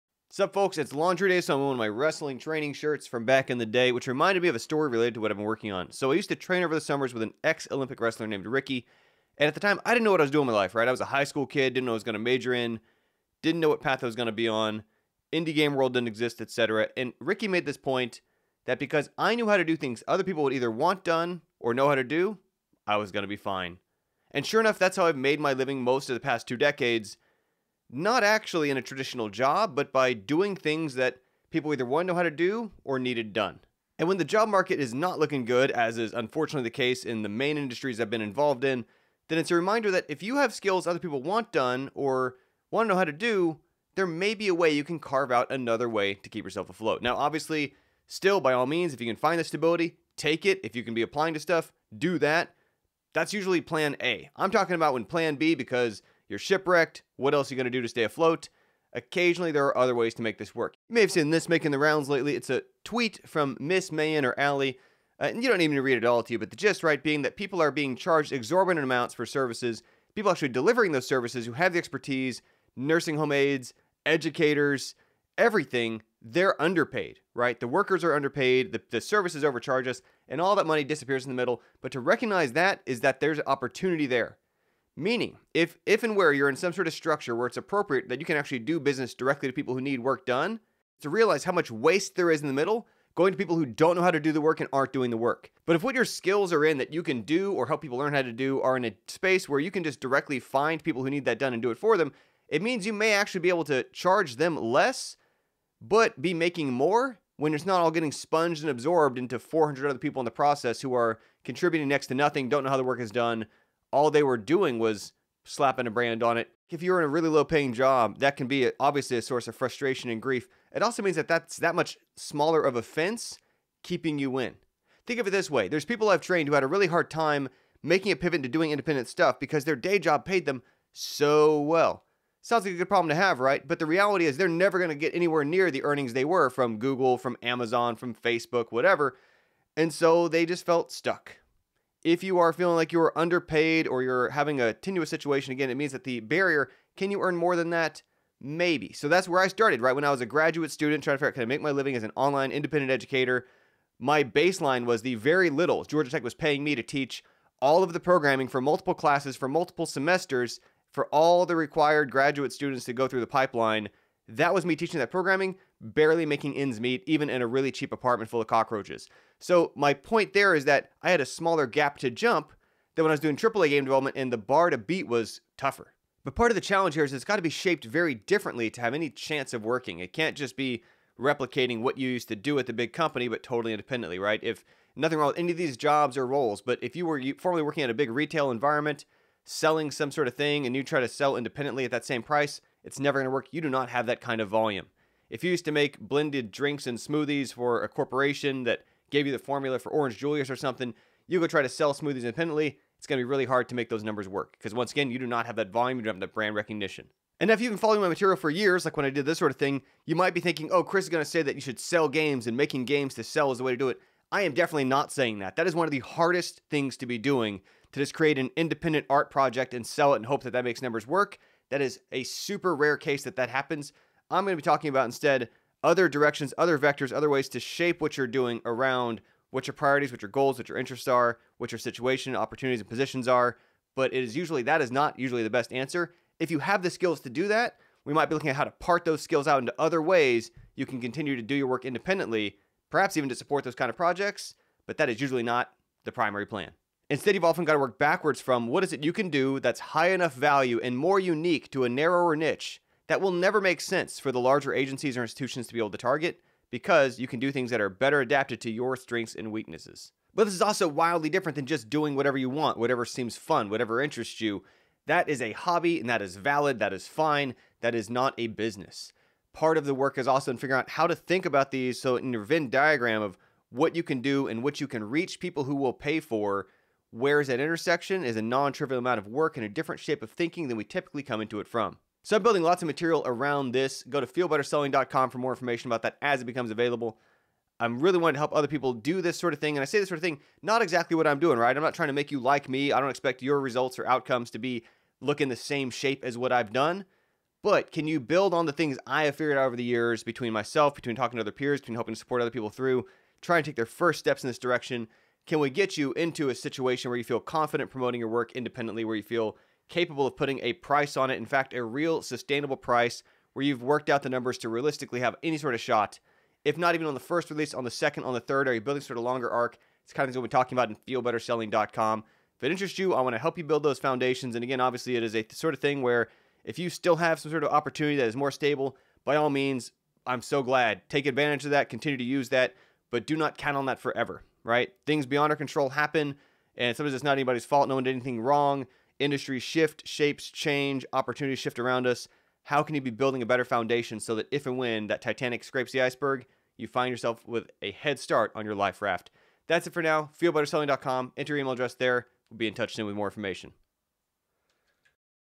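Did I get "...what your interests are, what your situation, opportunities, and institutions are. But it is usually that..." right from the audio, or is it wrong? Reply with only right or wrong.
wrong.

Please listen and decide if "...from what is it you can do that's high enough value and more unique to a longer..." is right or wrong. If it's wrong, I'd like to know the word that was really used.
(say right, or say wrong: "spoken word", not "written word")
wrong: "narrower", not "longer".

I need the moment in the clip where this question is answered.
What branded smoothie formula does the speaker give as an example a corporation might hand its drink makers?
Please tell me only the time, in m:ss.
3:19.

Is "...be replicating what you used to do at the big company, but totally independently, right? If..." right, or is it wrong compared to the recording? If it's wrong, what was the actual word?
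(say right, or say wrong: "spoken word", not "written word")
right.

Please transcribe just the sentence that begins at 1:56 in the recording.
If you're in a really low paying job, that can be obviously a source of frustration and grief.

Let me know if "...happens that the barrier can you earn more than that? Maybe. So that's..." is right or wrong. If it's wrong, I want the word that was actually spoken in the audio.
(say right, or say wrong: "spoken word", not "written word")
wrong: "means", not "happens".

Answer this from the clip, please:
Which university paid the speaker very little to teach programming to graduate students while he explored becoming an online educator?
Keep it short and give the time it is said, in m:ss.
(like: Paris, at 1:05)
Georgia Tech, at 2:35.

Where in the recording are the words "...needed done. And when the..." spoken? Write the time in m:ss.
0:32.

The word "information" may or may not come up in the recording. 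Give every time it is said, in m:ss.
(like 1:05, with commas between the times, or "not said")
4:45, 5:53.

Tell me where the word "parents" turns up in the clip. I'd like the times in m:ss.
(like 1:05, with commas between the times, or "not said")
not said.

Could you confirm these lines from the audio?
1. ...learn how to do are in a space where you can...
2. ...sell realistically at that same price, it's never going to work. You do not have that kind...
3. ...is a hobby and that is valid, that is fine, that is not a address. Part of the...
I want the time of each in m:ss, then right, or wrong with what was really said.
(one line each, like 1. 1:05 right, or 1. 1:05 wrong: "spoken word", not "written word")
1. 1:37 right
2. 3:11 wrong: "independently", not "realistically"
3. 4:25 wrong: "business", not "address".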